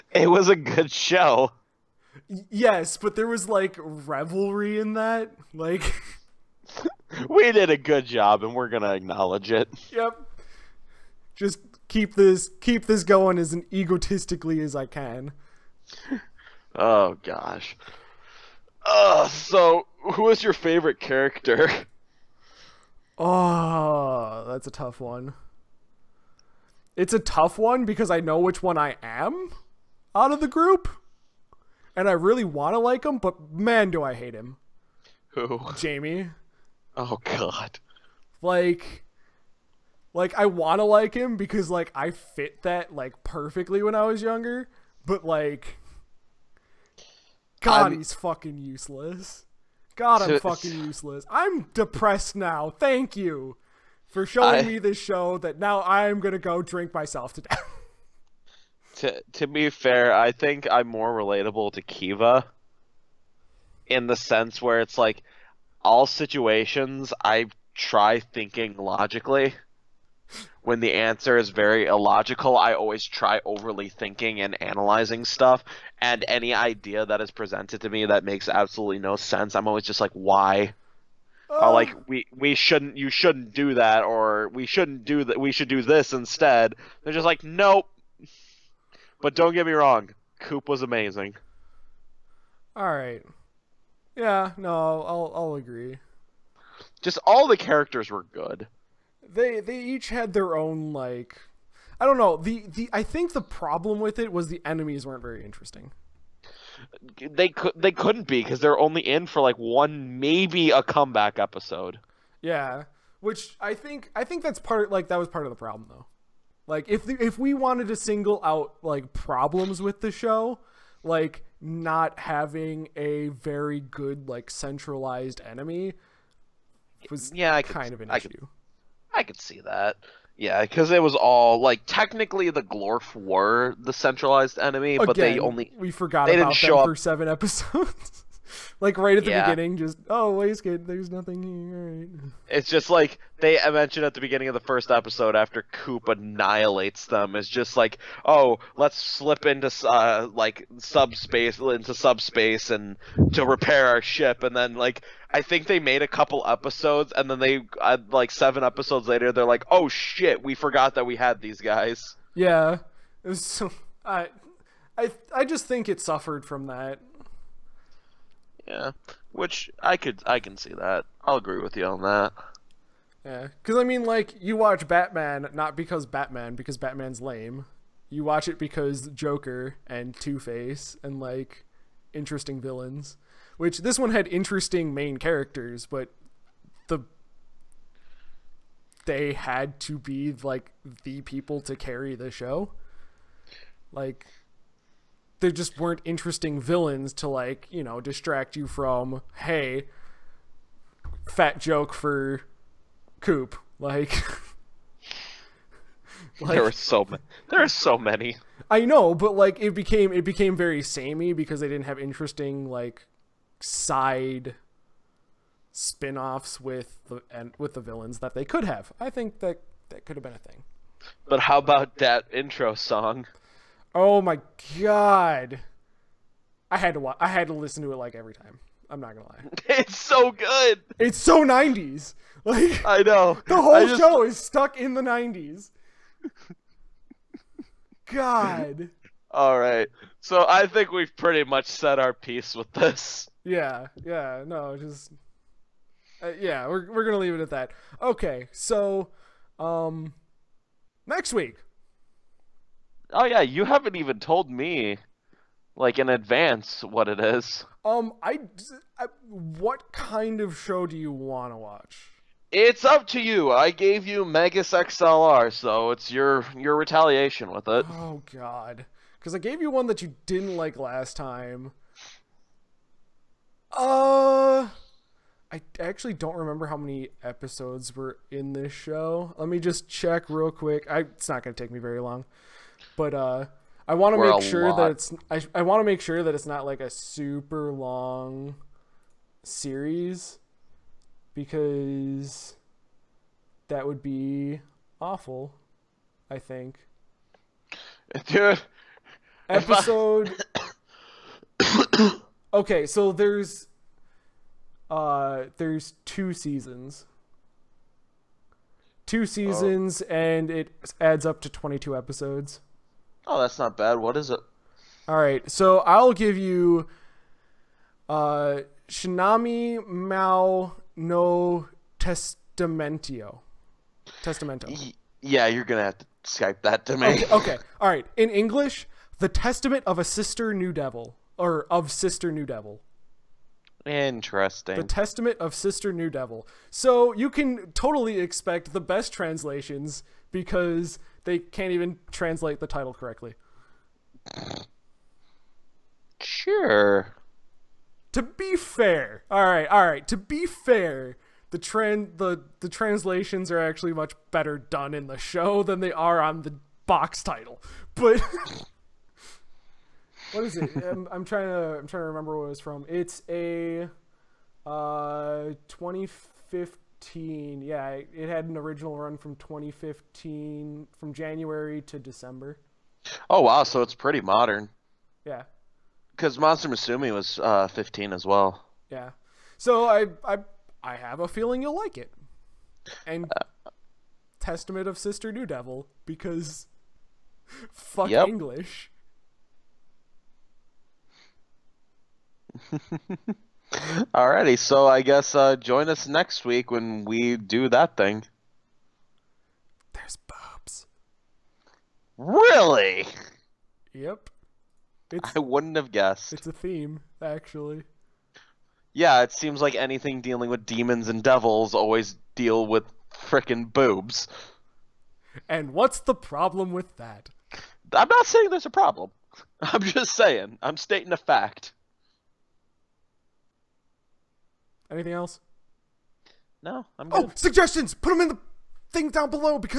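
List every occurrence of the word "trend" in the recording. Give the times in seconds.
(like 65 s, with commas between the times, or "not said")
351 s.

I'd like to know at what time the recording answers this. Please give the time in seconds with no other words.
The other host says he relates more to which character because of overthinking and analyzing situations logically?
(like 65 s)
61 s.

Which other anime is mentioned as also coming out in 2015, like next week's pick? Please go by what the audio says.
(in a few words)
Monster Musume.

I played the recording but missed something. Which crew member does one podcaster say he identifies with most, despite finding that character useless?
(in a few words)
Jamie.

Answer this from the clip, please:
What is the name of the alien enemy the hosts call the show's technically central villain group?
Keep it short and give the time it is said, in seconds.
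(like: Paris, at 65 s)
Glorf, at 132 s.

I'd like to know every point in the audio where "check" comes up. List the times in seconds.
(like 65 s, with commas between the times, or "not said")
279 s.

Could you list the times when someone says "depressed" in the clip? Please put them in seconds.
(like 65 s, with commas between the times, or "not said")
51 s.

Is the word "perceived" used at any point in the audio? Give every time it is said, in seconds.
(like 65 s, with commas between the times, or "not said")
not said.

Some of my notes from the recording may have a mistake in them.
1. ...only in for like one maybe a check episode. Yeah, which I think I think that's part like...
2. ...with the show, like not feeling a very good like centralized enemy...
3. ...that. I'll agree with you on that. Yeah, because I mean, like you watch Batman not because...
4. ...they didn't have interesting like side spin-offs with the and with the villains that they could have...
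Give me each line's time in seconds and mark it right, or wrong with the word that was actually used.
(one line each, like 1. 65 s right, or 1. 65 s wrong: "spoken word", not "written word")
1. 108 s wrong: "comeback", not "check"
2. 119 s wrong: "having", not "feeling"
3. 170 s right
4. 211 s right.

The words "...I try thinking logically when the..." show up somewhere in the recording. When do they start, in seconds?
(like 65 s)
67 s.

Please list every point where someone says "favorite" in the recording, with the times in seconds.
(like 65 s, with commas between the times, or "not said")
20 s.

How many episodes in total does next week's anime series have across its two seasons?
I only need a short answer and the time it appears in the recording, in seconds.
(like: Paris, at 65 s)
22, at 311 s.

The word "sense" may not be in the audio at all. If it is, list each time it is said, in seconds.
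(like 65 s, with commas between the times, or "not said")
64 s, 79 s.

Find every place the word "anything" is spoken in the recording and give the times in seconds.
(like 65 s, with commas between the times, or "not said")
409 s, 424 s.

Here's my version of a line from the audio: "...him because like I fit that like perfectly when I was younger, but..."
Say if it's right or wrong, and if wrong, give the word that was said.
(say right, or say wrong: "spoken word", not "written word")
right.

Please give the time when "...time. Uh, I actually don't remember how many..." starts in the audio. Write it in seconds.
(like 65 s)
271 s.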